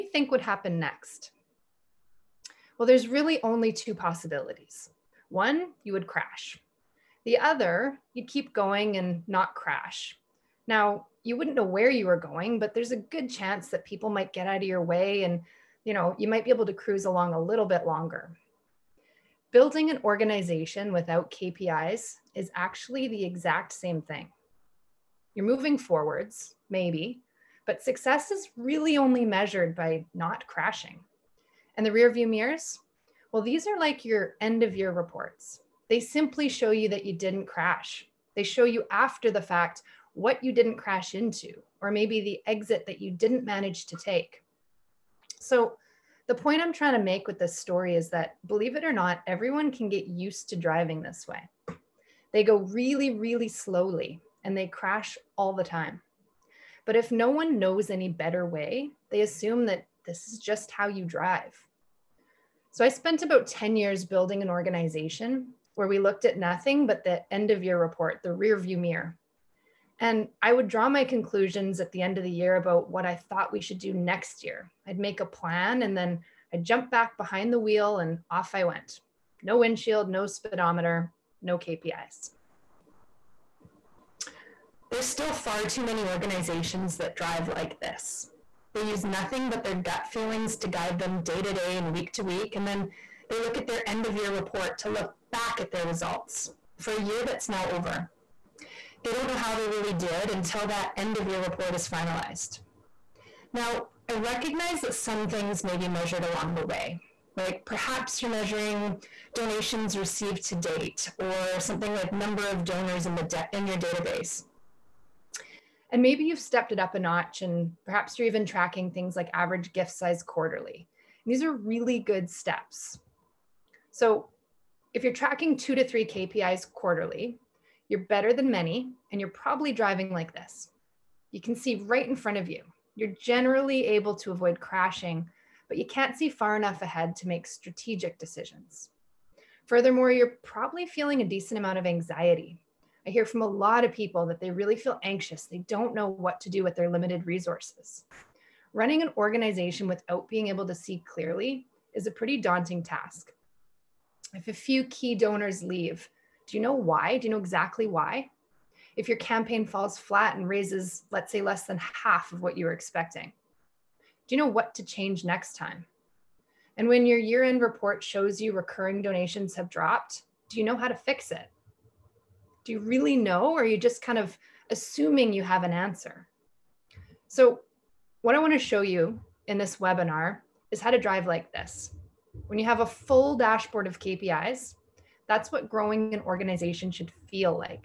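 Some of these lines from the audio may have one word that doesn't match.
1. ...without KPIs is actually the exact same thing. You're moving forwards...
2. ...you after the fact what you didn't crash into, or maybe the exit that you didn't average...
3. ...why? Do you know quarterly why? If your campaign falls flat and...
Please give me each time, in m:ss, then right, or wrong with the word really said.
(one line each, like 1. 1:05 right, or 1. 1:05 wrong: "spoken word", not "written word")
1. 0:20 right
2. 0:38 wrong: "manage", not "average"
3. 2:36 wrong: "exactly", not "quarterly".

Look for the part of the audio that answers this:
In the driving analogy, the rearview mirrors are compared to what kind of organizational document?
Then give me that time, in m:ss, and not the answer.
0:34.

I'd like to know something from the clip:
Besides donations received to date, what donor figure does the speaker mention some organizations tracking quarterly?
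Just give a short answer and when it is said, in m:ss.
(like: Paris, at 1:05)
Average gift size, at 1:59.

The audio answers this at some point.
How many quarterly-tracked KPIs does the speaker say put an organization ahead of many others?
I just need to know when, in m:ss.
2:05.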